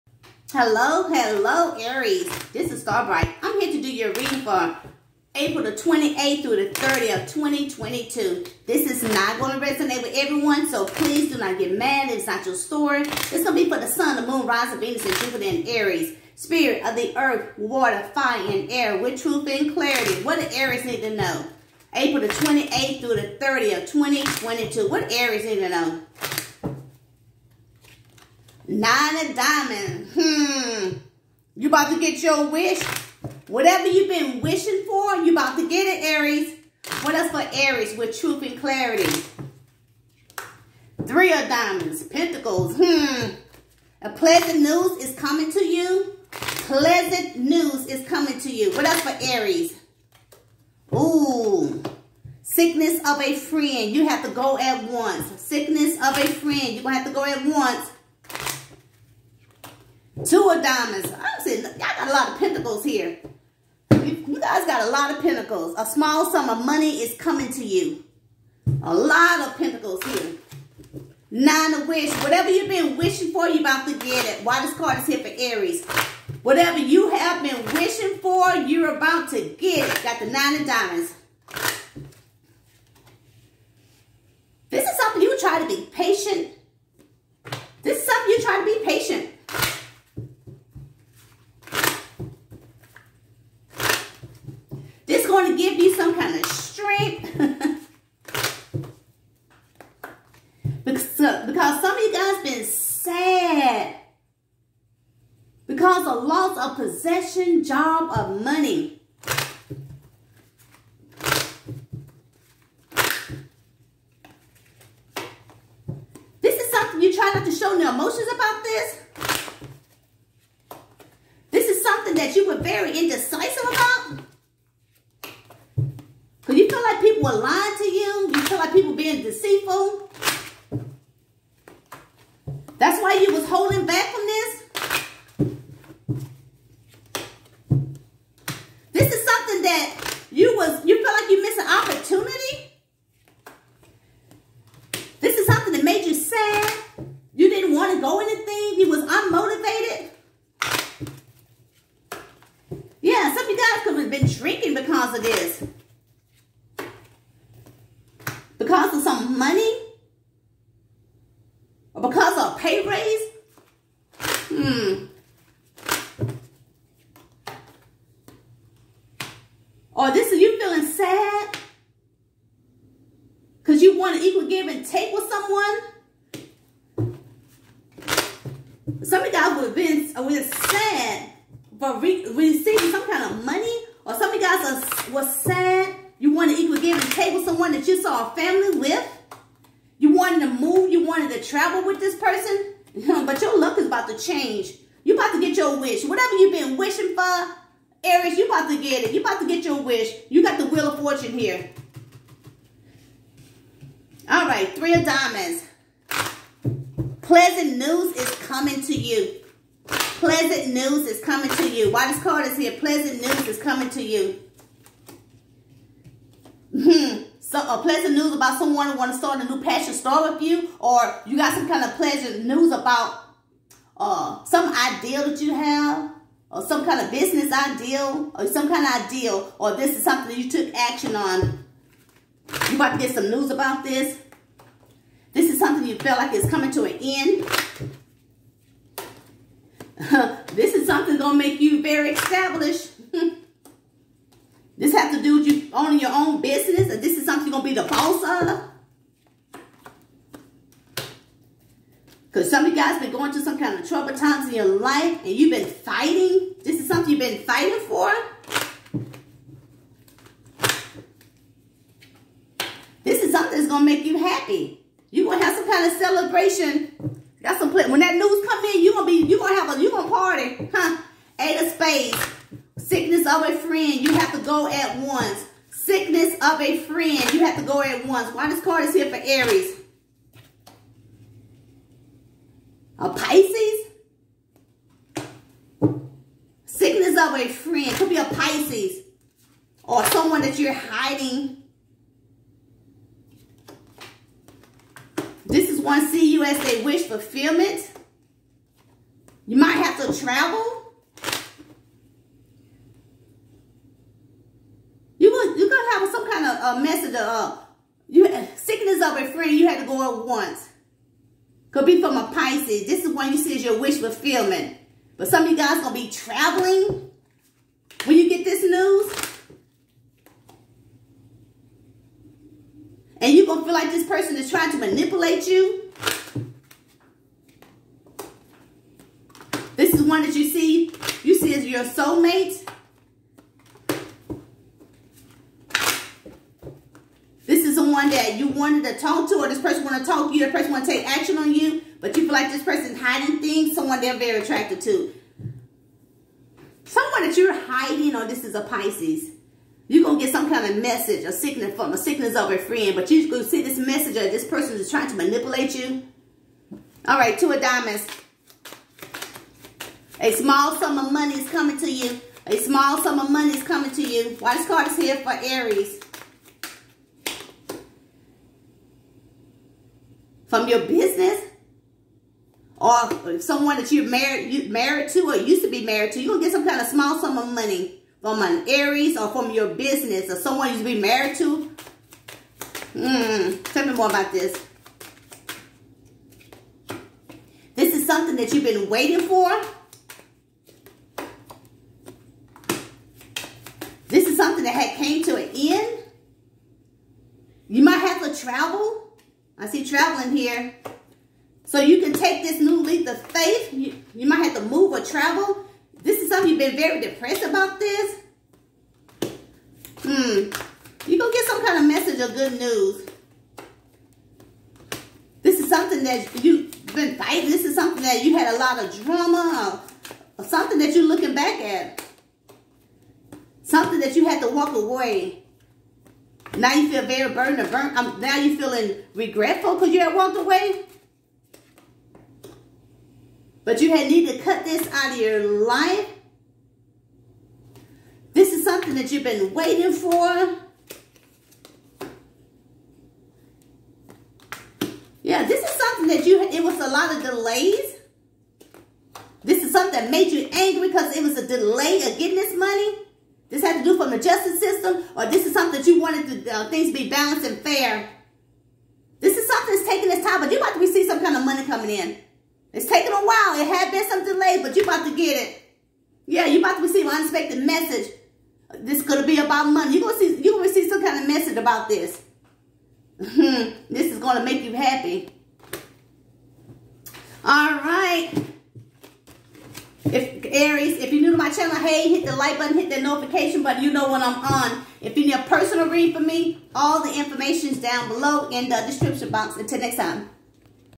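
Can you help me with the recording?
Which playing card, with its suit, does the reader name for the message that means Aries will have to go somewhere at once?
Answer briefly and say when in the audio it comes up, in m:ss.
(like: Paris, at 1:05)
Eight of spades, at 4:31.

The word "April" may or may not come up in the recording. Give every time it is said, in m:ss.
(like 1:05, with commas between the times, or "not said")
0:05, 0:21.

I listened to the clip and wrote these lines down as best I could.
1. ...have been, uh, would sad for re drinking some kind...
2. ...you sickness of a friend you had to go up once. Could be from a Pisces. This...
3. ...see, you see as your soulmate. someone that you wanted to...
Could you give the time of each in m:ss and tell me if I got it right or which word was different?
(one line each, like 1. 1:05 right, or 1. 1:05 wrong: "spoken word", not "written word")
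1. 2:59 wrong: "receiving", not "drinking"
2. 5:08 right
3. 5:30 right.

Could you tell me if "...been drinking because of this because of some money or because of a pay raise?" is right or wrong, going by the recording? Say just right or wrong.
right.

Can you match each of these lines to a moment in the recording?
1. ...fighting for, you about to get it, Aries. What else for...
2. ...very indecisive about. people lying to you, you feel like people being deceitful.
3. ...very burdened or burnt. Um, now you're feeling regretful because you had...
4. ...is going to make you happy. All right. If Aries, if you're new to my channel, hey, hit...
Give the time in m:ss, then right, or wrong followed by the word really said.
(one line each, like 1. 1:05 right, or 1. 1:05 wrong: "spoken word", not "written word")
1. 0:34 wrong: "wishing", not "fighting"
2. 2:02 right
3. 7:07 right
4. 7:54 right.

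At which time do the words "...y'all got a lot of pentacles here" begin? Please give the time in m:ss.
1:01.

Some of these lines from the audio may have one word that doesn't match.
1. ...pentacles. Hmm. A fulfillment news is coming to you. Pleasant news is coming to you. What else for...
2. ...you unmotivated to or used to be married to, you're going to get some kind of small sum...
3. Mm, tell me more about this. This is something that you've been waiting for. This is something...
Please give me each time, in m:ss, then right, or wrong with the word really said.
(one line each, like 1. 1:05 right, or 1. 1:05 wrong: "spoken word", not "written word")
1. 0:42 wrong: "pleasant", not "fulfillment"
2. 6:14 wrong: "married", not "unmotivated"
3. 6:22 right.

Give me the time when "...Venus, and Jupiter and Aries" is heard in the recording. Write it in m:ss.
0:14.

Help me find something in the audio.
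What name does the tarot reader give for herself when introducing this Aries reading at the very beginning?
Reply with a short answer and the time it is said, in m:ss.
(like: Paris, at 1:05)
Starbright, at 0:02.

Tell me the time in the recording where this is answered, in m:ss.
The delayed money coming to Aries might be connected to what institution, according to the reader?
7:34.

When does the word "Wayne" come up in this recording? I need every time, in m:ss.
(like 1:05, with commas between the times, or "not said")
not said.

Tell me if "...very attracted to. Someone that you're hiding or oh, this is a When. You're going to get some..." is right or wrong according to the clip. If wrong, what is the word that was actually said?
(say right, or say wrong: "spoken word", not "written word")
wrong: "Pisces", not "When".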